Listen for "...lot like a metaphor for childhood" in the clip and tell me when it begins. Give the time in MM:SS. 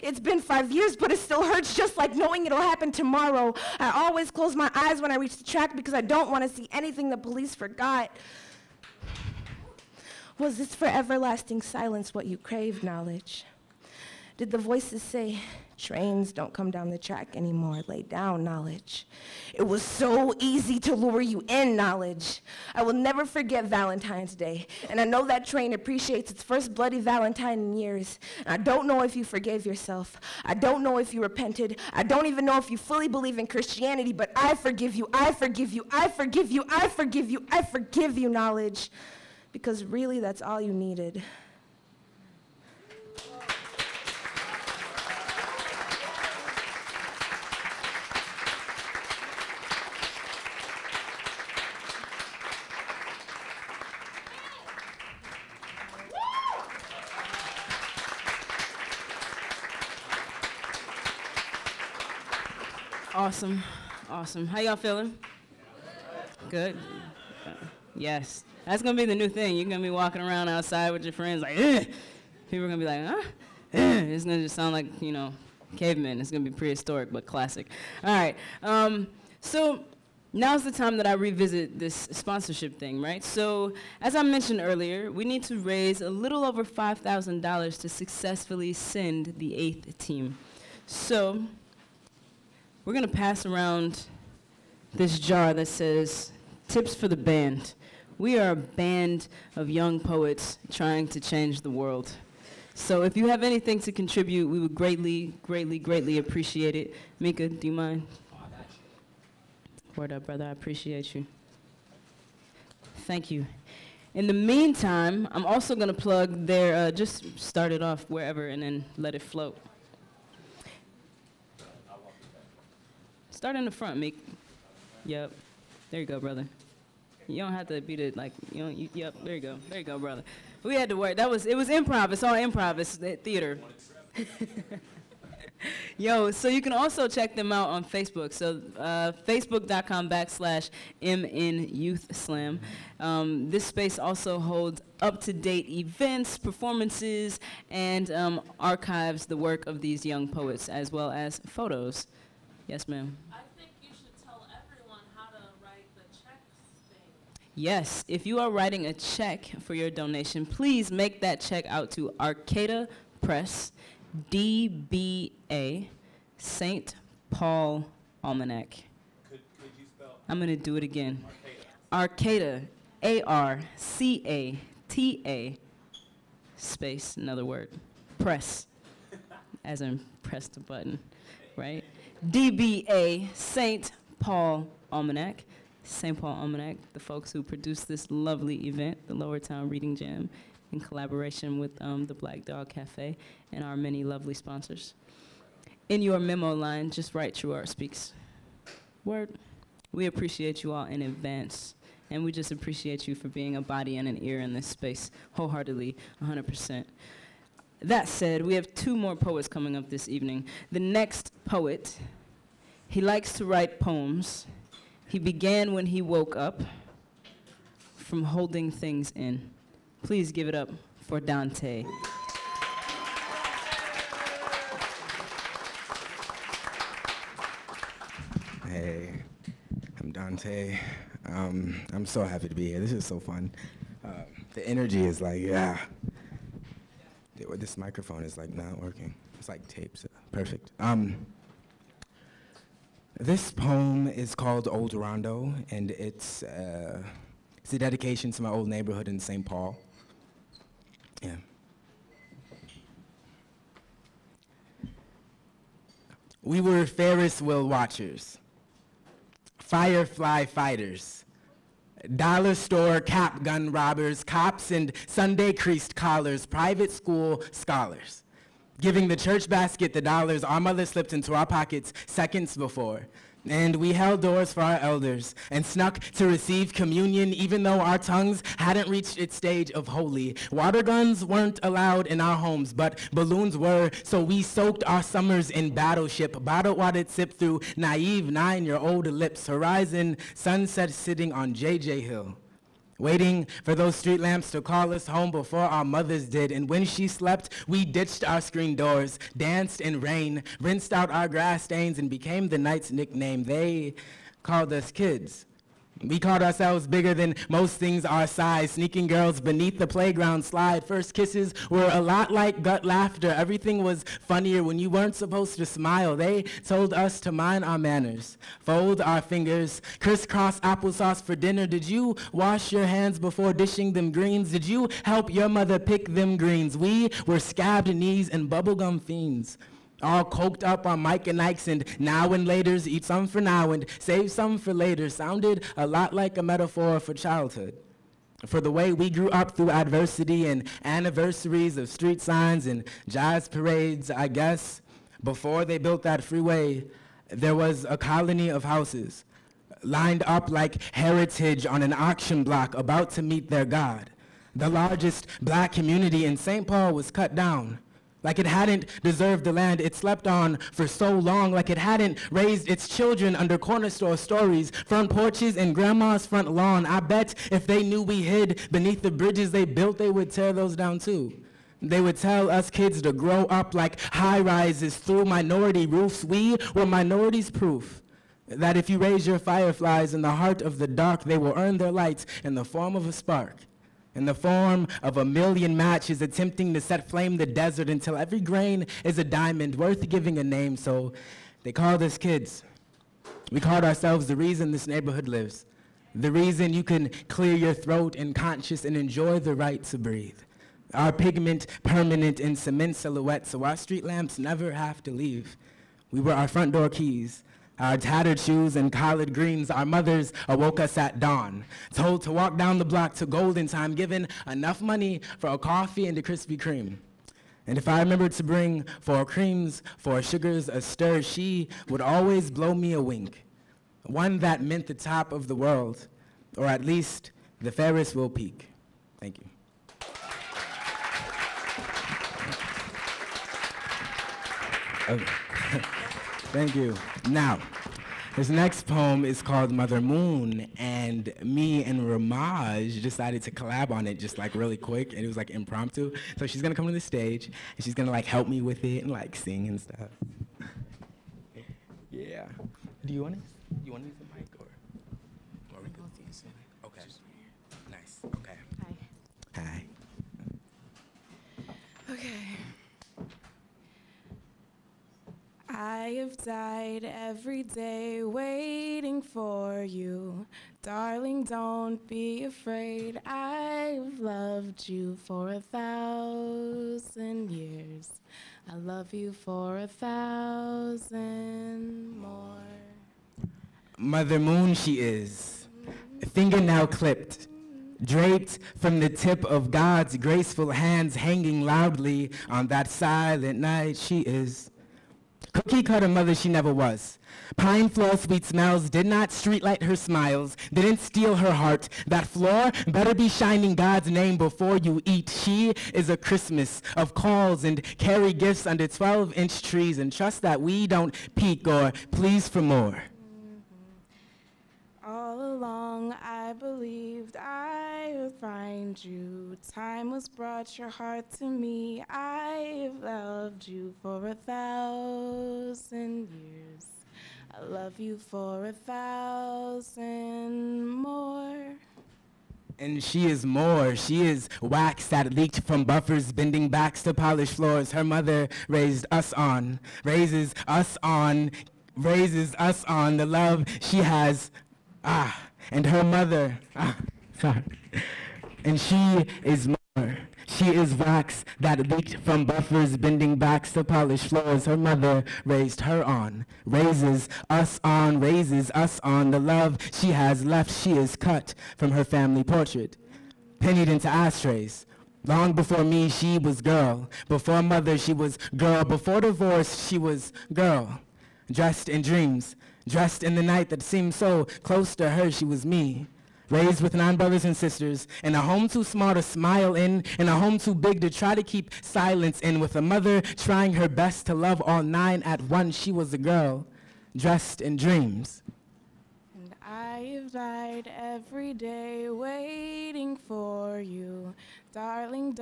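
05:35.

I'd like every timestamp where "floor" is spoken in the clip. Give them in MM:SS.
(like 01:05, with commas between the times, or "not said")
08:17, 08:22, 08:57, 09:14.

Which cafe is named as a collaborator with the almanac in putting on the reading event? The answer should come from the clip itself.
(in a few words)
Black Dog Cafe.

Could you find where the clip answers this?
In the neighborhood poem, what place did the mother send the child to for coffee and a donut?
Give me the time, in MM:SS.
06:53.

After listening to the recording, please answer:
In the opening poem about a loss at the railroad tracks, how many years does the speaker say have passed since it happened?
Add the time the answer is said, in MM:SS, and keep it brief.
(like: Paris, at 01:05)
5, at 00:00.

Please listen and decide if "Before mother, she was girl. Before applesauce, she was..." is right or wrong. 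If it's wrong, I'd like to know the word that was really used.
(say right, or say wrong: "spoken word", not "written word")
wrong: "divorce", not "applesauce".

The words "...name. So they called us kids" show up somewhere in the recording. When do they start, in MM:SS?
06:30.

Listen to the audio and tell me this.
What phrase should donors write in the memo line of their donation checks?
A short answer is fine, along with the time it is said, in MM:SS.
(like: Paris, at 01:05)
True Art Speaks, at 03:17.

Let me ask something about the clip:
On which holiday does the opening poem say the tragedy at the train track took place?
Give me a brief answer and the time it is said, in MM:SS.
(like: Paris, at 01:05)
Valentine's Day, at 00:23.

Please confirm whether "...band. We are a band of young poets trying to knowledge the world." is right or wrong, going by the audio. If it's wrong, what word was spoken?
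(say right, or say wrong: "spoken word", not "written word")
wrong: "change", not "knowledge".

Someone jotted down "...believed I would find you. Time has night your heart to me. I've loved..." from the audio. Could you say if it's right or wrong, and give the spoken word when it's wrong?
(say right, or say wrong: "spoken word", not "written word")
wrong: "brought", not "night".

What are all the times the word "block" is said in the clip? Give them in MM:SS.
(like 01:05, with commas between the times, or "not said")
05:52, 06:52.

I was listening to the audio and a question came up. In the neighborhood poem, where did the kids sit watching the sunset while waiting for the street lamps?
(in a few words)
J.J. Hill.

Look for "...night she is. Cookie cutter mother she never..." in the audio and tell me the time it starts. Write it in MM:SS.
08:13.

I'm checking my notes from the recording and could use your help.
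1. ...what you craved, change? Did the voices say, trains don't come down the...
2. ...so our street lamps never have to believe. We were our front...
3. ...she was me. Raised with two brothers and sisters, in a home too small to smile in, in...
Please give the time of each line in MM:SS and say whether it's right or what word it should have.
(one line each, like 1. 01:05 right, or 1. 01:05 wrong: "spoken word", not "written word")
1. 00:12 wrong: "knowledge", not "change"
2. 06:43 wrong: "leave", not "believe"
3. 09:35 wrong: "nine", not "two".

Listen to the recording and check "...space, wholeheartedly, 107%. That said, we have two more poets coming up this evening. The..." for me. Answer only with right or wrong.
wrong.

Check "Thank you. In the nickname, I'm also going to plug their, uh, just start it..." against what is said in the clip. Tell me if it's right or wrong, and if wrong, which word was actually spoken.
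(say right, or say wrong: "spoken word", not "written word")
wrong: "meantime", not "nickname".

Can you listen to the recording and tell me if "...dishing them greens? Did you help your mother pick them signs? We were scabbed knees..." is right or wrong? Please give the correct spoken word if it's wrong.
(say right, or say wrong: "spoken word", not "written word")
wrong: "greens", not "signs".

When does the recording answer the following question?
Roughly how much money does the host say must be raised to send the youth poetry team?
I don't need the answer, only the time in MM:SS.
01:26.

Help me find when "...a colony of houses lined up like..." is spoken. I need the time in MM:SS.
05:47.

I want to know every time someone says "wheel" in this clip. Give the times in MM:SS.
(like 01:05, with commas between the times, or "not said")
04:17.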